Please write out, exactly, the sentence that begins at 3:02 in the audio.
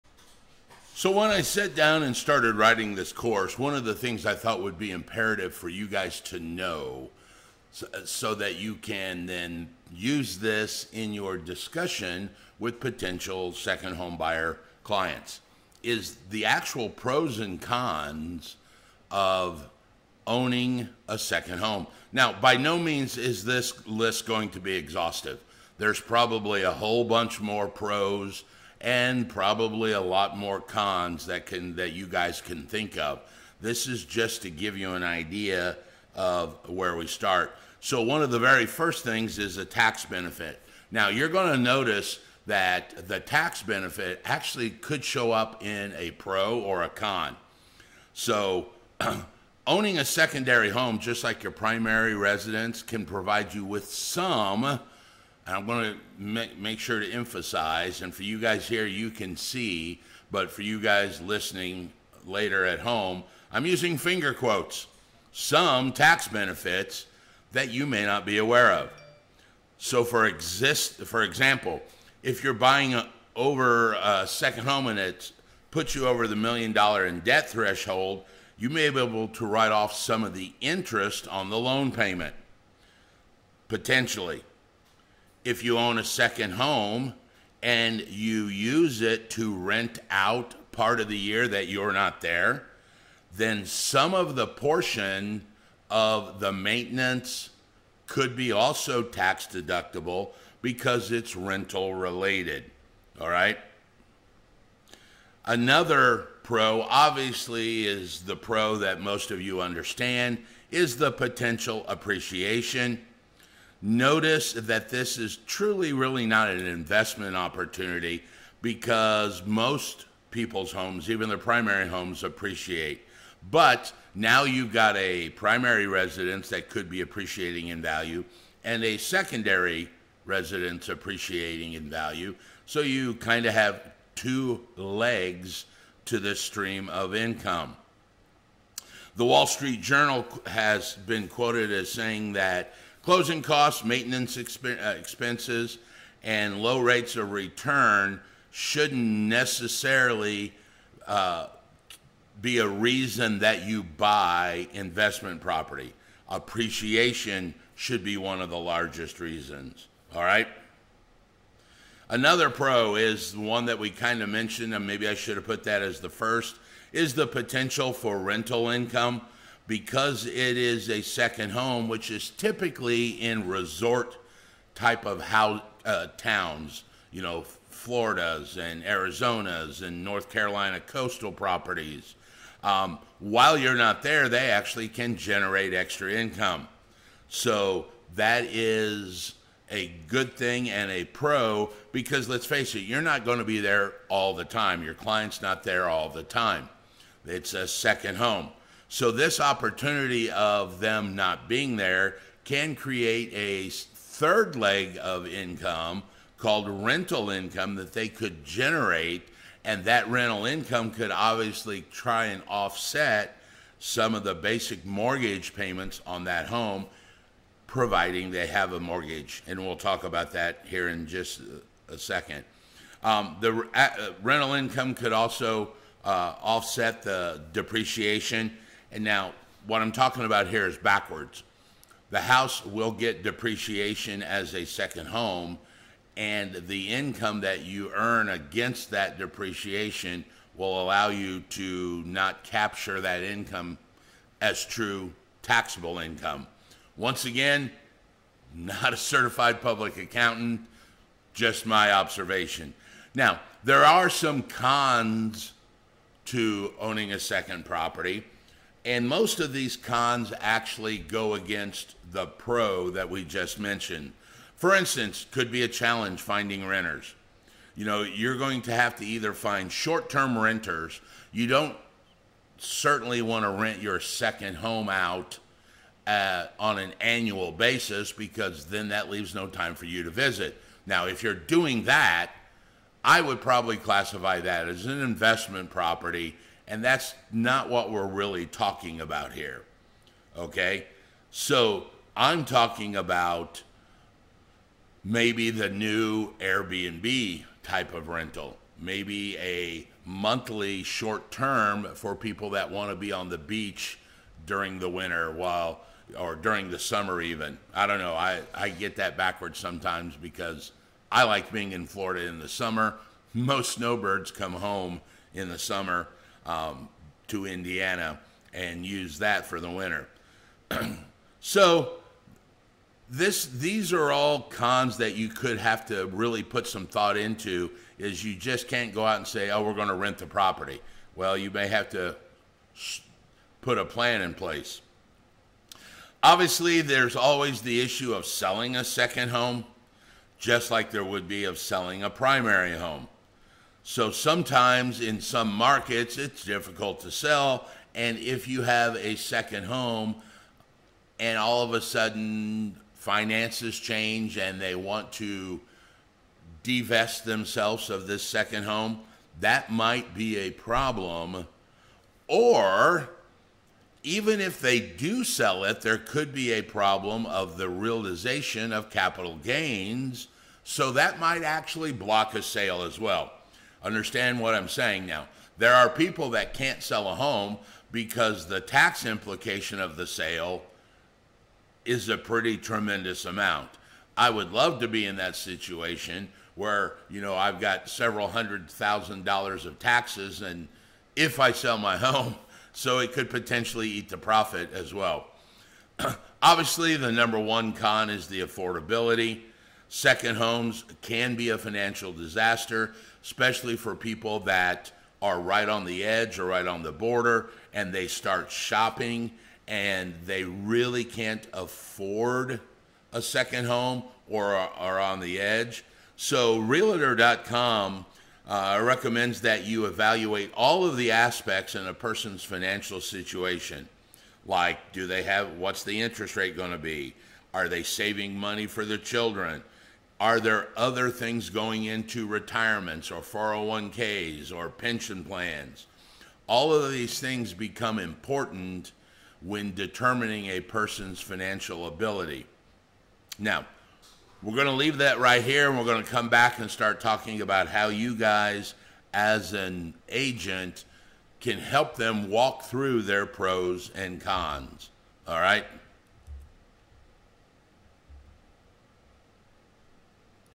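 Um, while you're not there, they actually can generate extra income.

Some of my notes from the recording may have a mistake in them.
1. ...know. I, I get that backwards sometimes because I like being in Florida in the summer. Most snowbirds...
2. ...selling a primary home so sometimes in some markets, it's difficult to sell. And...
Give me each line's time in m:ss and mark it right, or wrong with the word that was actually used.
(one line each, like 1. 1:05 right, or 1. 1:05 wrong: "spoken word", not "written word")
1. 5:07 right
2. 5:41 right.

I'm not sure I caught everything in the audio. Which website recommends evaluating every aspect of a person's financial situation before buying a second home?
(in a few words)
Realtor.com.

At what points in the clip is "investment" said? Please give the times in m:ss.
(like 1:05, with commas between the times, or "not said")
1:56, 2:34, 4:45.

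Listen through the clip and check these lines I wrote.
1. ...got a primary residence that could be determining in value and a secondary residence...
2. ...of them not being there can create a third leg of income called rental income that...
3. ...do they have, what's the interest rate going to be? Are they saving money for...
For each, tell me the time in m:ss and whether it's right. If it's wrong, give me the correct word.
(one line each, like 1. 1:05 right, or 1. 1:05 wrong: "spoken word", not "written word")
1. 2:04 wrong: "appreciating", not "determining"
2. 3:20 right
3. 7:04 right.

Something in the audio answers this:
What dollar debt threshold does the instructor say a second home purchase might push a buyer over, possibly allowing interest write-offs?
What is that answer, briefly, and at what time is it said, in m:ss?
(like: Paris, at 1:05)
million dollar, at 1:16.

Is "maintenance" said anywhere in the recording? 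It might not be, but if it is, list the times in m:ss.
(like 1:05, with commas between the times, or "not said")
1:36, 2:23.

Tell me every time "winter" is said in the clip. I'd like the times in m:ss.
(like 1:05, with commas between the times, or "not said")
5:04, 5:19.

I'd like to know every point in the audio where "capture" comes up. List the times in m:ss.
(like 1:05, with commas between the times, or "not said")
4:02.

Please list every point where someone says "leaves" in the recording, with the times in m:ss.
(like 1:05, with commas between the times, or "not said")
4:39, 7:24.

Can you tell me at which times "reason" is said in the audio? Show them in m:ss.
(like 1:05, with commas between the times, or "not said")
2:32, 2:39.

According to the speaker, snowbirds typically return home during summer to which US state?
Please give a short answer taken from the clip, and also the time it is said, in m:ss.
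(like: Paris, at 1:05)
Indiana, at 5:17.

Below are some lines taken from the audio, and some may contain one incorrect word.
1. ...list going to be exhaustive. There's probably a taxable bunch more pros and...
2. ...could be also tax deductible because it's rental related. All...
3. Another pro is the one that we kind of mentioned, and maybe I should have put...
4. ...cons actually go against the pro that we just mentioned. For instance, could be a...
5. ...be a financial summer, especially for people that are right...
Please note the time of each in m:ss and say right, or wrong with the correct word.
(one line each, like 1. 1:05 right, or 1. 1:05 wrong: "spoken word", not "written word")
1. 0:23 wrong: "whole", not "taxable"
2. 1:38 right
3. 2:42 right
4. 4:19 right
5. 6:41 wrong: "disaster", not "summer".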